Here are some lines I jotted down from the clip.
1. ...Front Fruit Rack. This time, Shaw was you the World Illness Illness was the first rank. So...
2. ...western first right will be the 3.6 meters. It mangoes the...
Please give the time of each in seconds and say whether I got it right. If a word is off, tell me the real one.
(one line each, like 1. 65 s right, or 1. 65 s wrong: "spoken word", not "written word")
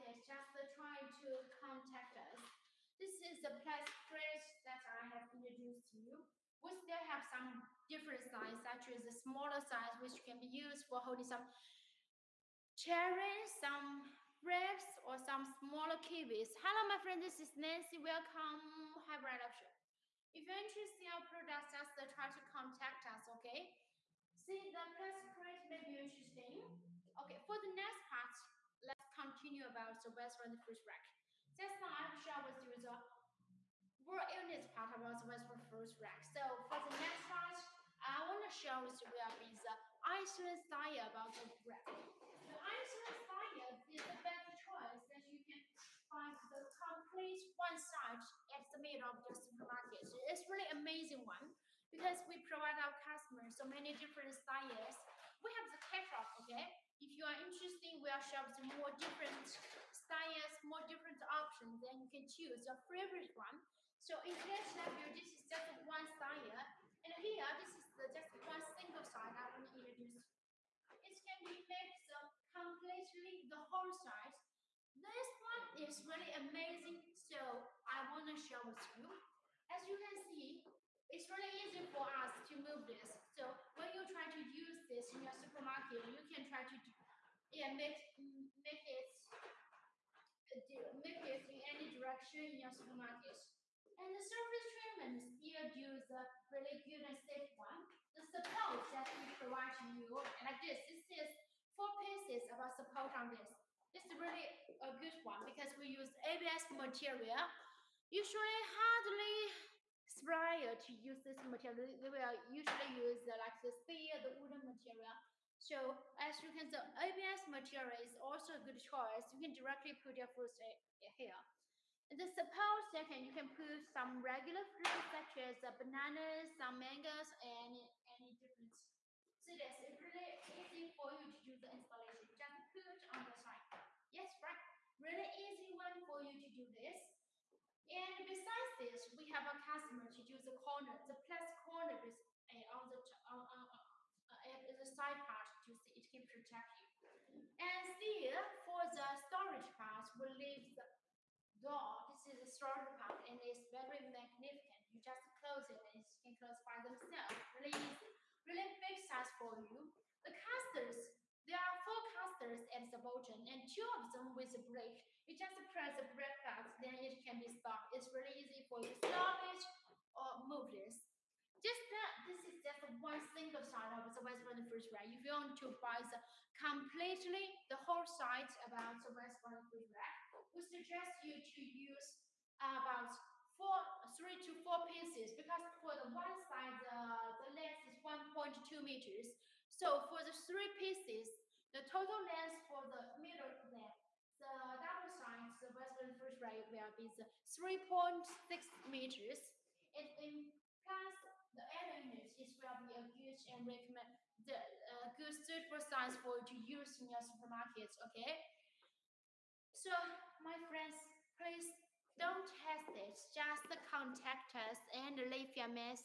1. 30 s wrong: "Part", not "Illness"
2. 195 s wrong: "implies", not "mangoes".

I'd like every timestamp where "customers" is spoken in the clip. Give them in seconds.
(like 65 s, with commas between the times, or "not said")
53 s, 139 s.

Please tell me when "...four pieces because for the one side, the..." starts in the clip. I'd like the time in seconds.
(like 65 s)
184 s.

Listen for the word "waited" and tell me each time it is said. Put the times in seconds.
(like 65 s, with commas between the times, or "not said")
not said.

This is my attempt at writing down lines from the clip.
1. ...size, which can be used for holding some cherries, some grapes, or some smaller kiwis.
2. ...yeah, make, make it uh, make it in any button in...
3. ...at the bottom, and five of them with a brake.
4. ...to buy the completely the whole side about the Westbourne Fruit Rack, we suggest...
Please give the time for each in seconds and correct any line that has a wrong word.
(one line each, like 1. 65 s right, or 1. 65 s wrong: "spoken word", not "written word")
1. 9 s right
2. 87 s wrong: "direction", not "button"
3. 162 s wrong: "two", not "five"
4. 175 s right.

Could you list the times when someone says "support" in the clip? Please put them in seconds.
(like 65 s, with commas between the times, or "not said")
98 s, 102 s, 122 s.